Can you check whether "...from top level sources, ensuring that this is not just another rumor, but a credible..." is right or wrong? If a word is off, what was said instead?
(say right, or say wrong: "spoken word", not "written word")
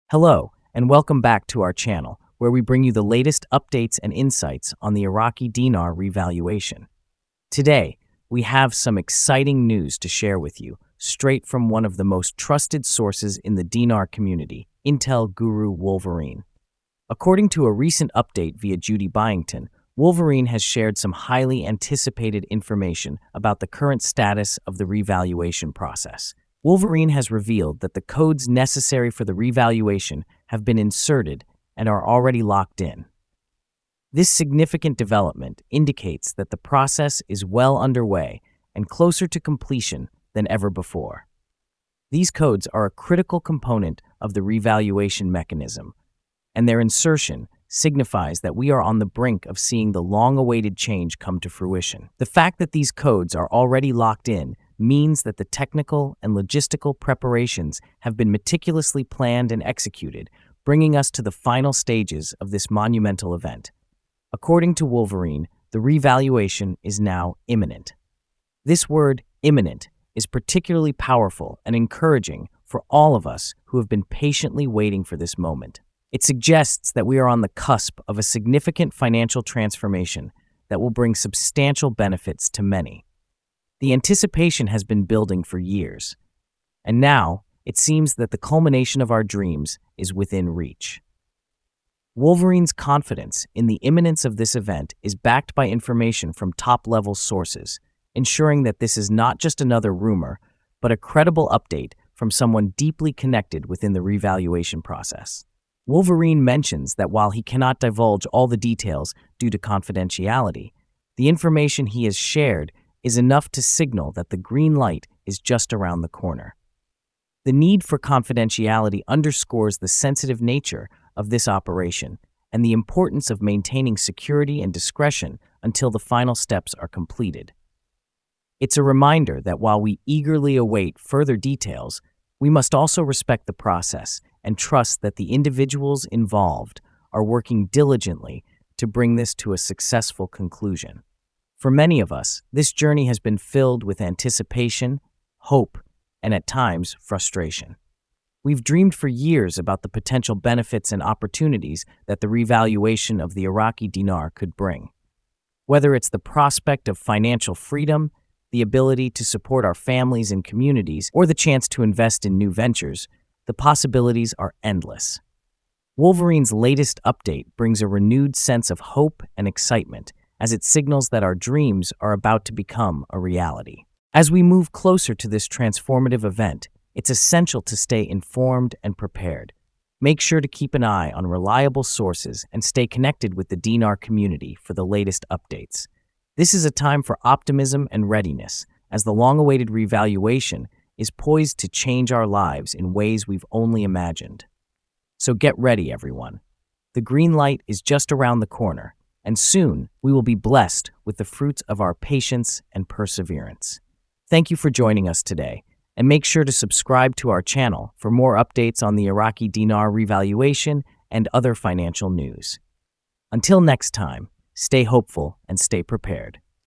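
right.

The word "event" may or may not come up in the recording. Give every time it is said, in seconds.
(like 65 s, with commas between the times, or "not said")
63 s, 94 s, 176 s.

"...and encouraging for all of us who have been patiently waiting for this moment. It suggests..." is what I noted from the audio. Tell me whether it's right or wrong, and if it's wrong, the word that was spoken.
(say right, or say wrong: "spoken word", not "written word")
right.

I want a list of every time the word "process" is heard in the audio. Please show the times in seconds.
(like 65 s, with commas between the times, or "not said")
25 s, 36 s, 104 s, 133 s.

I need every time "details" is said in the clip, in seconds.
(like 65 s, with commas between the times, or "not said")
108 s, 131 s.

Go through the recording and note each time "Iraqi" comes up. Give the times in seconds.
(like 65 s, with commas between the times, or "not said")
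5 s, 153 s, 209 s.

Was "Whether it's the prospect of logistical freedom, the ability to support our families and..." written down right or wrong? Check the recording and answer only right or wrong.
wrong.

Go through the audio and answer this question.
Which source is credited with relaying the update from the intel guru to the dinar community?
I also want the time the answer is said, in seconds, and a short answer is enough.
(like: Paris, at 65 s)
Judy Byington, at 18 s.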